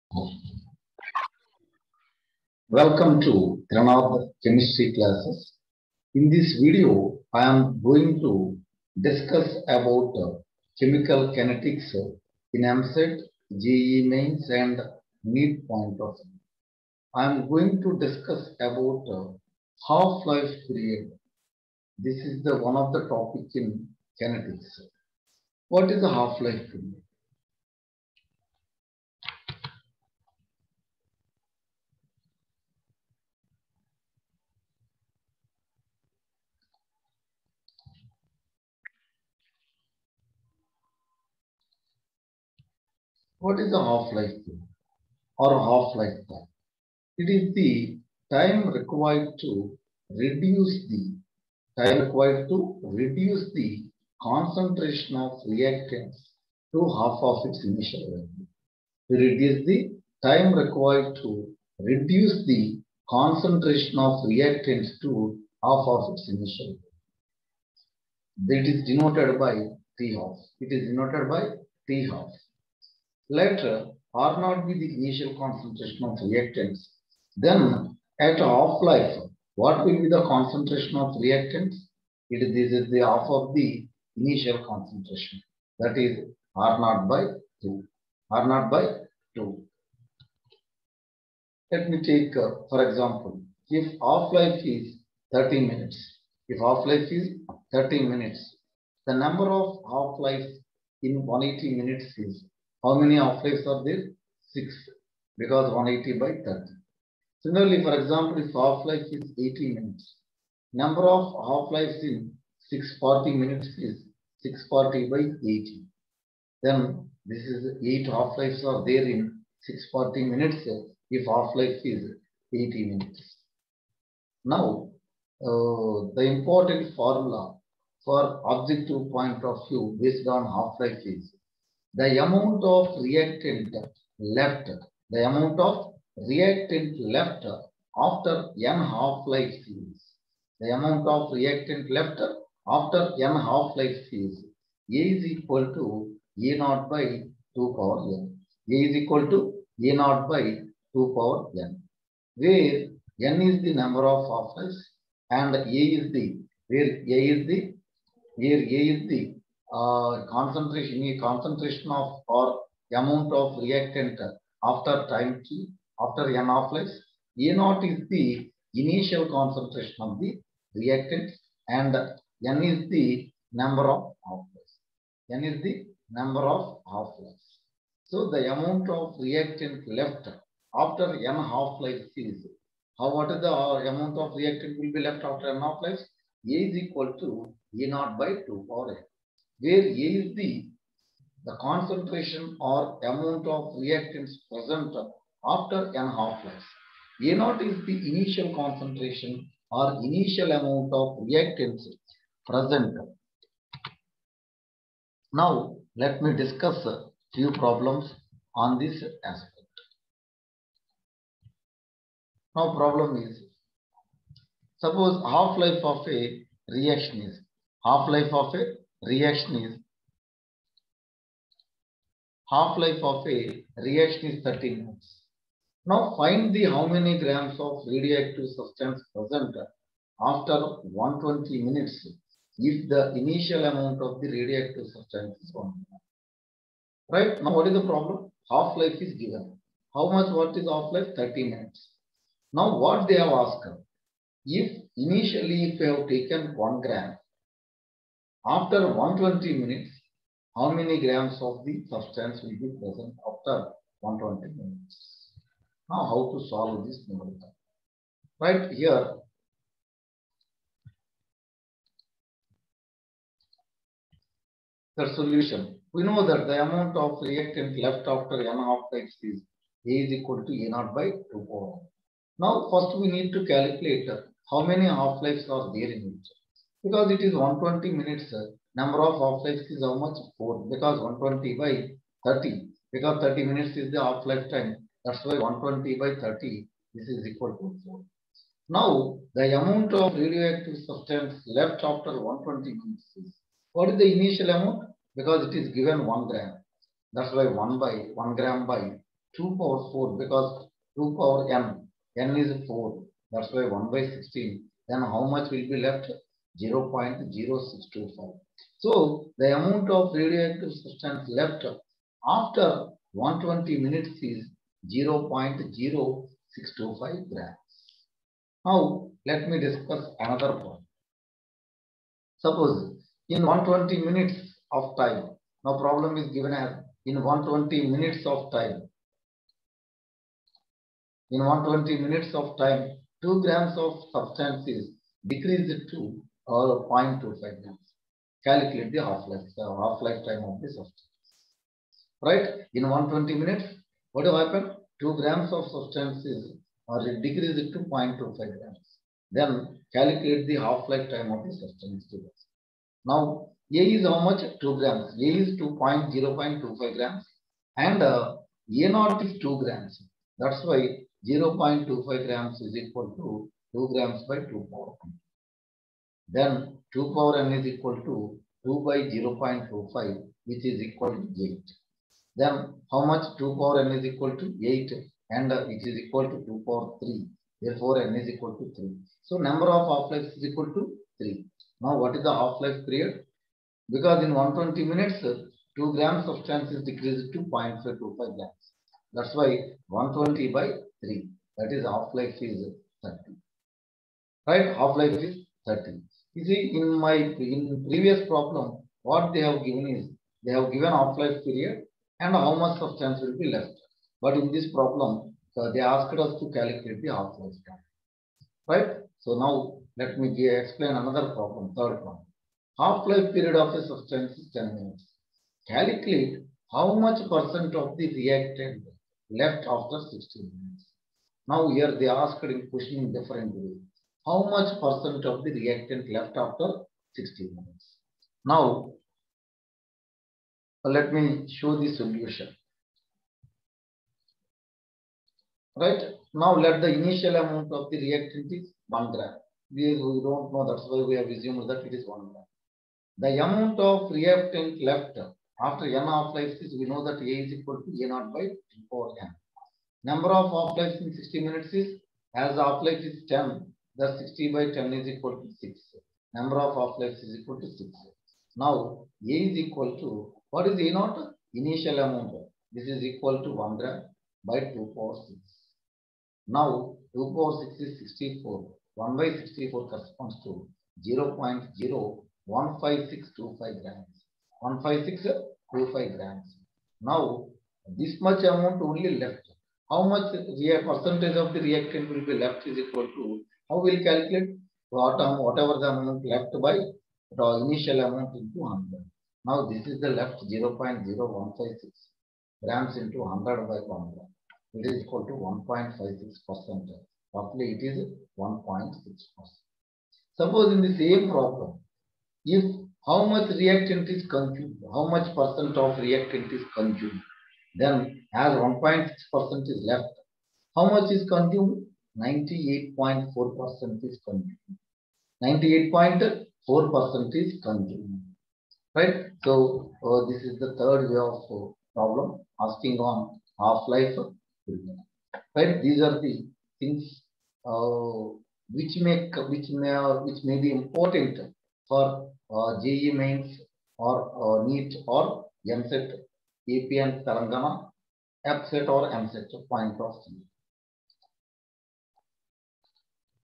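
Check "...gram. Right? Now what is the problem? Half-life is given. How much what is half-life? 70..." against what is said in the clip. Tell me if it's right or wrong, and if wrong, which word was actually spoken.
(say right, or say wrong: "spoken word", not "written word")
wrong: "30", not "70".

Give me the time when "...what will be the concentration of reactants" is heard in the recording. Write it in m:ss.
1:19.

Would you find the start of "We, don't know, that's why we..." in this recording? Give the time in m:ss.
7:19.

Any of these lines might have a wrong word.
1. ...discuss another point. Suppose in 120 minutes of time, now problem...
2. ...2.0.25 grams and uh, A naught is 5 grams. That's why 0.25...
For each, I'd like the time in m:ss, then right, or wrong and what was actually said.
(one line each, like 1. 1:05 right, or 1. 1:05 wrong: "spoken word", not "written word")
1. 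5:19 right
2. 5:55 wrong: "2", not "5".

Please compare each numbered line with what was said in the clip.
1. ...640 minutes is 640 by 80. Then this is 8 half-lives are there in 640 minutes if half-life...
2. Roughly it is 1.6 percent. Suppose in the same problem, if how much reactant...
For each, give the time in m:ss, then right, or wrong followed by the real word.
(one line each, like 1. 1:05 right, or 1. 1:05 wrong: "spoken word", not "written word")
1. 1:52 right
2. 8:17 right.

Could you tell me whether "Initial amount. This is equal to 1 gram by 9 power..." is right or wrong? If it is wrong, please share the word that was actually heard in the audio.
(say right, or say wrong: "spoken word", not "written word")
wrong: "2", not "9".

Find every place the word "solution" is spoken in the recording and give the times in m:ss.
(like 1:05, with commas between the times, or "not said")
4:25, 7:11.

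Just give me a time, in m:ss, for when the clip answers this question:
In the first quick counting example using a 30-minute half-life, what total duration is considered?
1:41.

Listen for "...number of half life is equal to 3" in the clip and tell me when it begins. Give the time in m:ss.
6:19.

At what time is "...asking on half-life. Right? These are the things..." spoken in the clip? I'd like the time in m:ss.
8:42.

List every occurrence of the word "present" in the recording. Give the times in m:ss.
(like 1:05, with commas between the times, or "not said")
3:14, 3:22, 3:49, 4:12.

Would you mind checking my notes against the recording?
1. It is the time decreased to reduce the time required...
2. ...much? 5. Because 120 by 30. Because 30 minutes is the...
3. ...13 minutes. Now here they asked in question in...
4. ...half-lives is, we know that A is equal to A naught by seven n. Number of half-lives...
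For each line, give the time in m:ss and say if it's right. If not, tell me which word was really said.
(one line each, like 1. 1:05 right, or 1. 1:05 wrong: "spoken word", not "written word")
1. 0:47 wrong: "required", not "decreased"
2. 4:39 wrong: "4", not "5"
3. 7:00 wrong: "16", not "13"
4. 7:26 wrong: "four", not "seven".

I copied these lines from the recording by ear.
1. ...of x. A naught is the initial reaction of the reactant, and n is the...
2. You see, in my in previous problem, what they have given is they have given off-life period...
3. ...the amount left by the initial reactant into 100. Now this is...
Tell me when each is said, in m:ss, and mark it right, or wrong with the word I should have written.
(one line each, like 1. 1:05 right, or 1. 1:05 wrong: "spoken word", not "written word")
1. 2:46 wrong: "concentration", not "reaction"
2. 6:36 right
3. 8:05 wrong: "amount", not "reactant".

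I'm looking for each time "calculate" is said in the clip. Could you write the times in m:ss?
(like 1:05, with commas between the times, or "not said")
4:33, 5:38, 5:49, 6:46, 6:55, 8:04.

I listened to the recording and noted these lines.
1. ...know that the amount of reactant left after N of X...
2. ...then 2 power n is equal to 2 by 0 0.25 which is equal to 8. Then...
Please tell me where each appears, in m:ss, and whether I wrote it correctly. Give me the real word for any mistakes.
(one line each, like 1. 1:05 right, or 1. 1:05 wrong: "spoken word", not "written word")
1. 4:26 right
2. 6:06 right.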